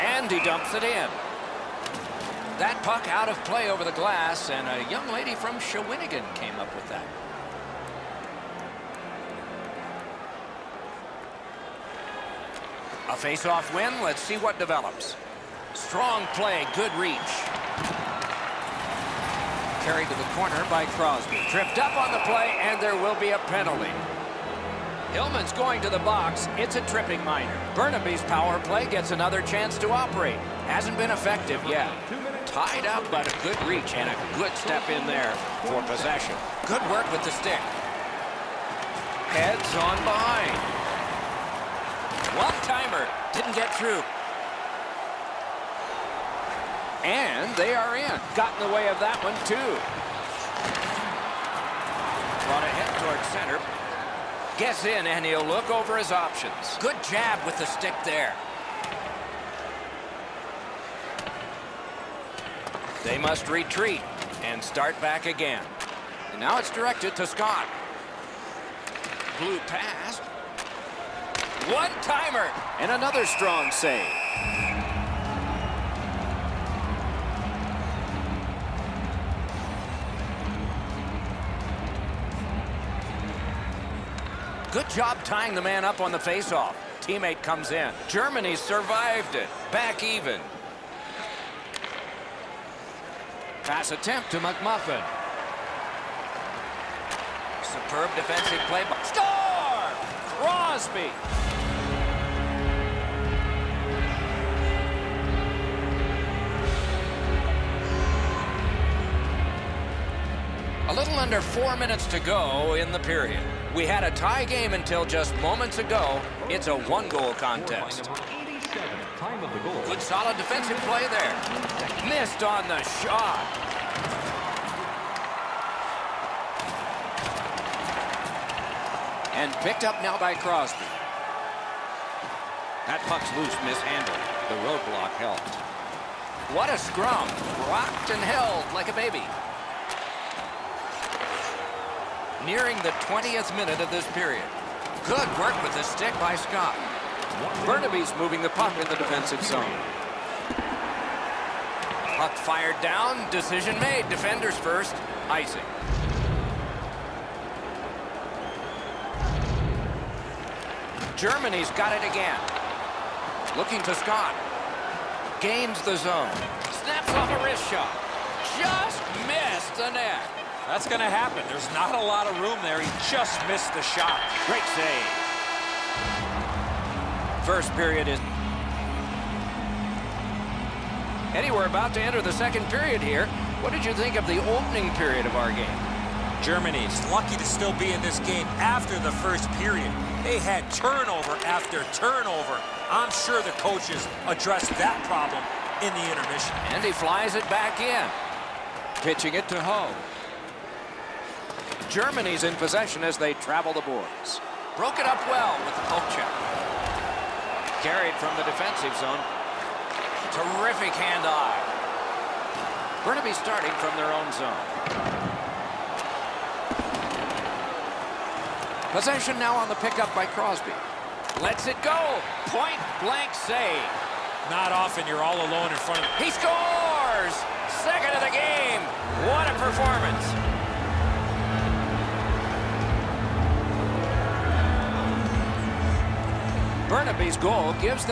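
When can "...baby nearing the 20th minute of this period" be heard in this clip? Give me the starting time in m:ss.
2:18.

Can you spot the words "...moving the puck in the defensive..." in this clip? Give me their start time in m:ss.
2:28.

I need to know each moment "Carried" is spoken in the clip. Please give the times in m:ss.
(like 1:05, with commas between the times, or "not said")
0:19, 3:27.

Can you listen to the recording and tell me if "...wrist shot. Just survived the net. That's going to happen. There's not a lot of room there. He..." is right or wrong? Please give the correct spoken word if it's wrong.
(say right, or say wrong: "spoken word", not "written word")
wrong: "missed", not "survived".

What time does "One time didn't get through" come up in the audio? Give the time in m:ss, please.
0:42.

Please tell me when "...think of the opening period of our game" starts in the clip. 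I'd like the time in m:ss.
3:03.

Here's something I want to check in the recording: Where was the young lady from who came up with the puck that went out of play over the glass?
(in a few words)
Shawinigan.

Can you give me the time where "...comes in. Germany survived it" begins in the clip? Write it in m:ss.
1:27.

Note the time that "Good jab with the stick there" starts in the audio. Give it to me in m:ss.
0:56.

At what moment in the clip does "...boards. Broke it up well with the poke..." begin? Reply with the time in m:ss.
3:23.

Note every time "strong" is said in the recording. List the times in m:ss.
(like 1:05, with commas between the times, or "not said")
0:15, 1:13.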